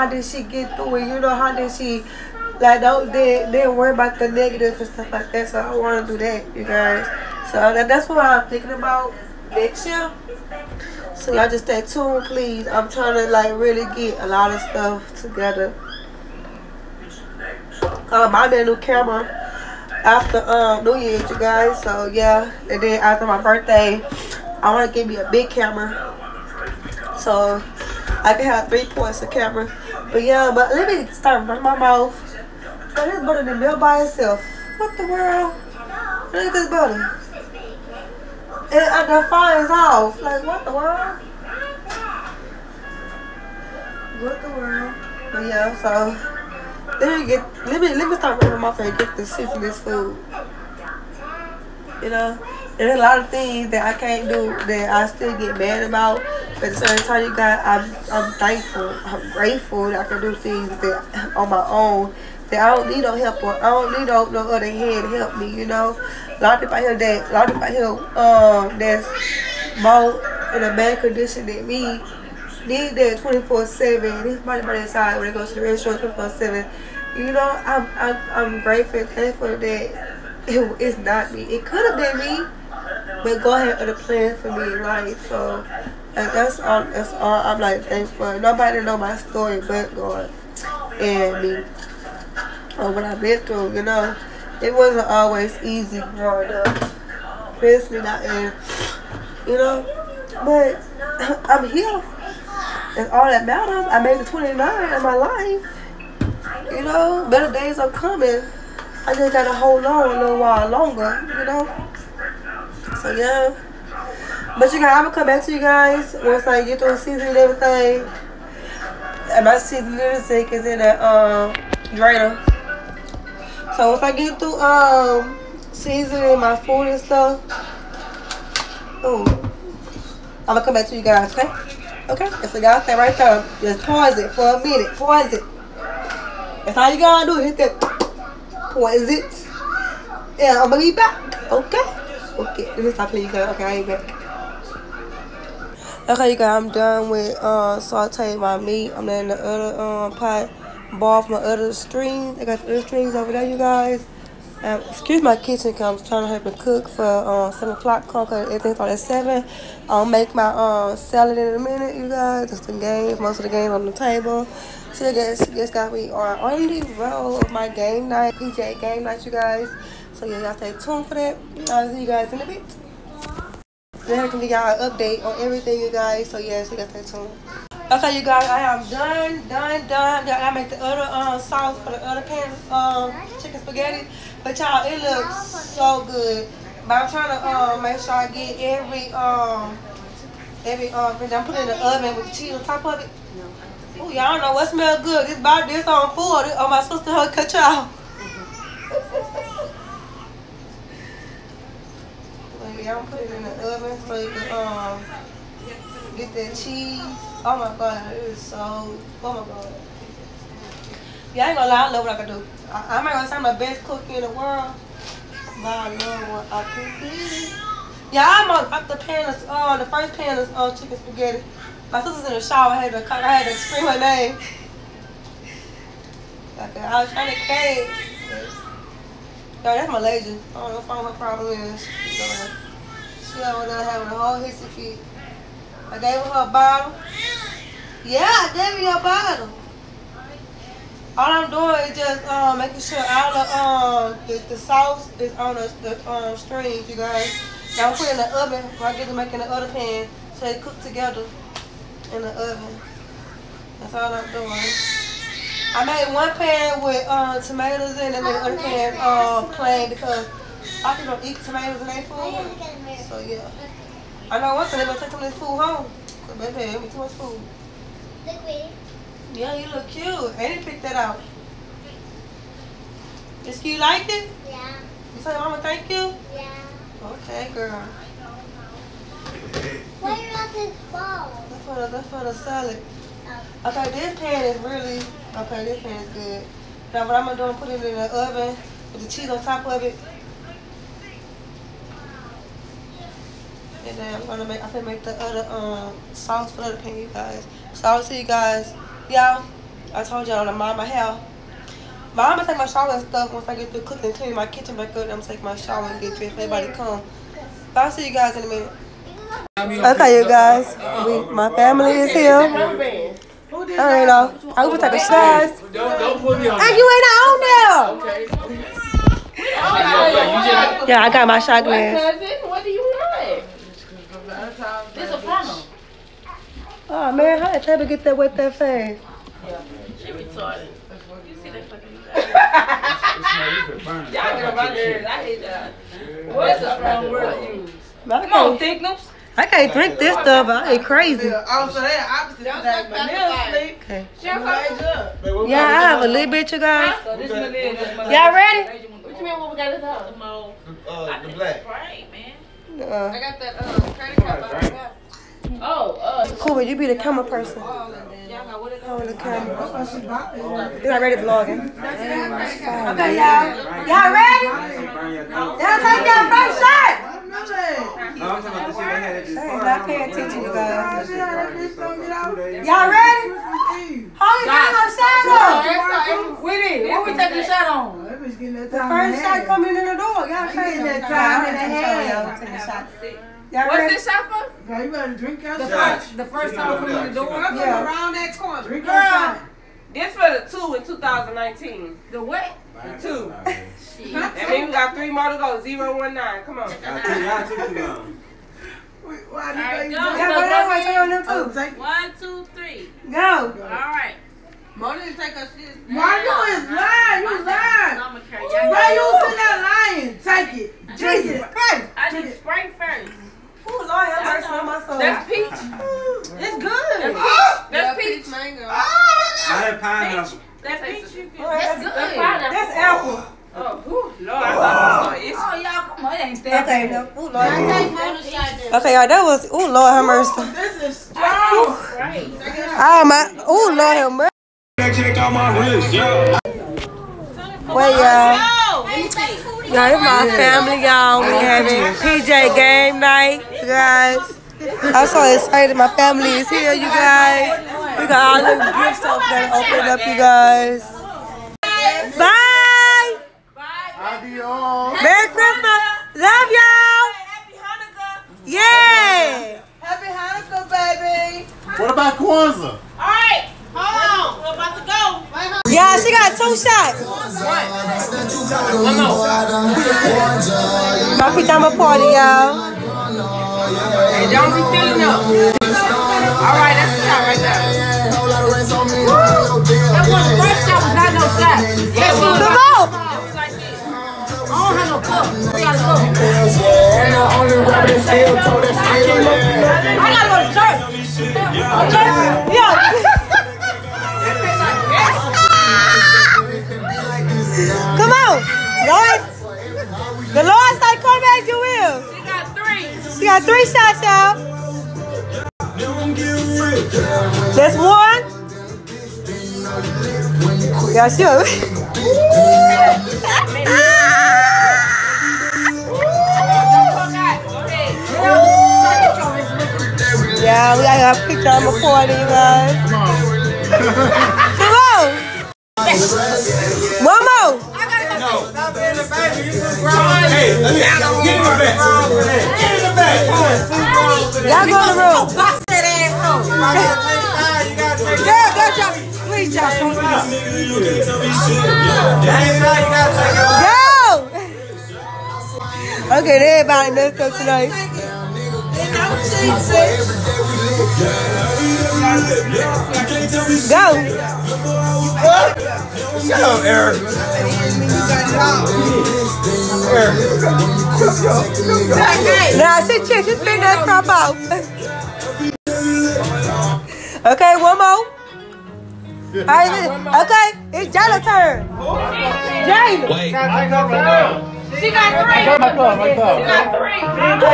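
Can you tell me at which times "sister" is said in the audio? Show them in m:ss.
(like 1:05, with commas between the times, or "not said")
3:16, 3:42.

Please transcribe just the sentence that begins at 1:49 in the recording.
I just gotta hold on a little while longer, you know.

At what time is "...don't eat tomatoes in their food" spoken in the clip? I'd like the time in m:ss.
4:21.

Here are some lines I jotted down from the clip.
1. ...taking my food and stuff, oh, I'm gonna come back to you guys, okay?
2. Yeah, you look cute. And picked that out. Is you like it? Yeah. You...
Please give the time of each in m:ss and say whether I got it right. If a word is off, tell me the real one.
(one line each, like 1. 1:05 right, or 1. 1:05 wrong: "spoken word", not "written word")
1. 2:05 wrong: "seasoning", not "taking"
2. 4:29 right.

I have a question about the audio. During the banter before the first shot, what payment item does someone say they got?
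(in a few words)
credit card.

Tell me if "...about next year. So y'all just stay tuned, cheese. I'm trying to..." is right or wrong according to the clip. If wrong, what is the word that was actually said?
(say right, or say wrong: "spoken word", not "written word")
wrong: "please", not "cheese".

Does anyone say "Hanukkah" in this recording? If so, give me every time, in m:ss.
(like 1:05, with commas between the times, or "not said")
7:40.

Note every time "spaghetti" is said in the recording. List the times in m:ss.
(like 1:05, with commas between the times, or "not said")
3:03, 3:40.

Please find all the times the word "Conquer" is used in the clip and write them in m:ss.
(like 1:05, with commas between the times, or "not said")
2:38.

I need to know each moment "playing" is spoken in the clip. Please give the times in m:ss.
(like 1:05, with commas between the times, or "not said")
2:23.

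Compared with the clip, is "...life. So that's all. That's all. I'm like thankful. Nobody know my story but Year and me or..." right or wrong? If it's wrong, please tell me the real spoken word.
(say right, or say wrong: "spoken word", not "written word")
wrong: "God", not "Year".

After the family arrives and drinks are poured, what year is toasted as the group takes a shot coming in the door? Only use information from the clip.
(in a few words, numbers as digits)
2019.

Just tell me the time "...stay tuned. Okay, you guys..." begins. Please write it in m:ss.
2:56.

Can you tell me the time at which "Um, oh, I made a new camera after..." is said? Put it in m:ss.
0:17.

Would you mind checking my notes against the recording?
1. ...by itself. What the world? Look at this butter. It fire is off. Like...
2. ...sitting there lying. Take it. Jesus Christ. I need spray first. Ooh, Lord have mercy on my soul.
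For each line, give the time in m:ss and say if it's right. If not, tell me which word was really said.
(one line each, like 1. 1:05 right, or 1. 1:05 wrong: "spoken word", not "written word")
1. 0:33 right
2. 6:50 right.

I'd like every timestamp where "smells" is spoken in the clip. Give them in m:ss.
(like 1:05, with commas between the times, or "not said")
3:14.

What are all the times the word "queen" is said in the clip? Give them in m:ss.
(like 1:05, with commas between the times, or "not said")
not said.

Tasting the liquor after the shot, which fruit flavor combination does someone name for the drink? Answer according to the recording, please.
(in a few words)
peach mango.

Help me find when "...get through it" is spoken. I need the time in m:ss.
0:00.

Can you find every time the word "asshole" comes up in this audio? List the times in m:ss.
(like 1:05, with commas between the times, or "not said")
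8:55.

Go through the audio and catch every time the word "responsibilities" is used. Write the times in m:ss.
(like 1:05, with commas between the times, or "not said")
not said.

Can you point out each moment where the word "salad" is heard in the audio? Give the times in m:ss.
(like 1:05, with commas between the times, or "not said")
2:40, 4:42.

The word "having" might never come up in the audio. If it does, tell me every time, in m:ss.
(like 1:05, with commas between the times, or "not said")
3:53, 7:21.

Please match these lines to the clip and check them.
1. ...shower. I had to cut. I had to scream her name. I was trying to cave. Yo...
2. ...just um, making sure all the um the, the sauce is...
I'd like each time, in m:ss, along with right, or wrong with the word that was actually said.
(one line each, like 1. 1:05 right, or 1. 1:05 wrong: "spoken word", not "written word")
1. 3:42 right
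2. 4:01 right.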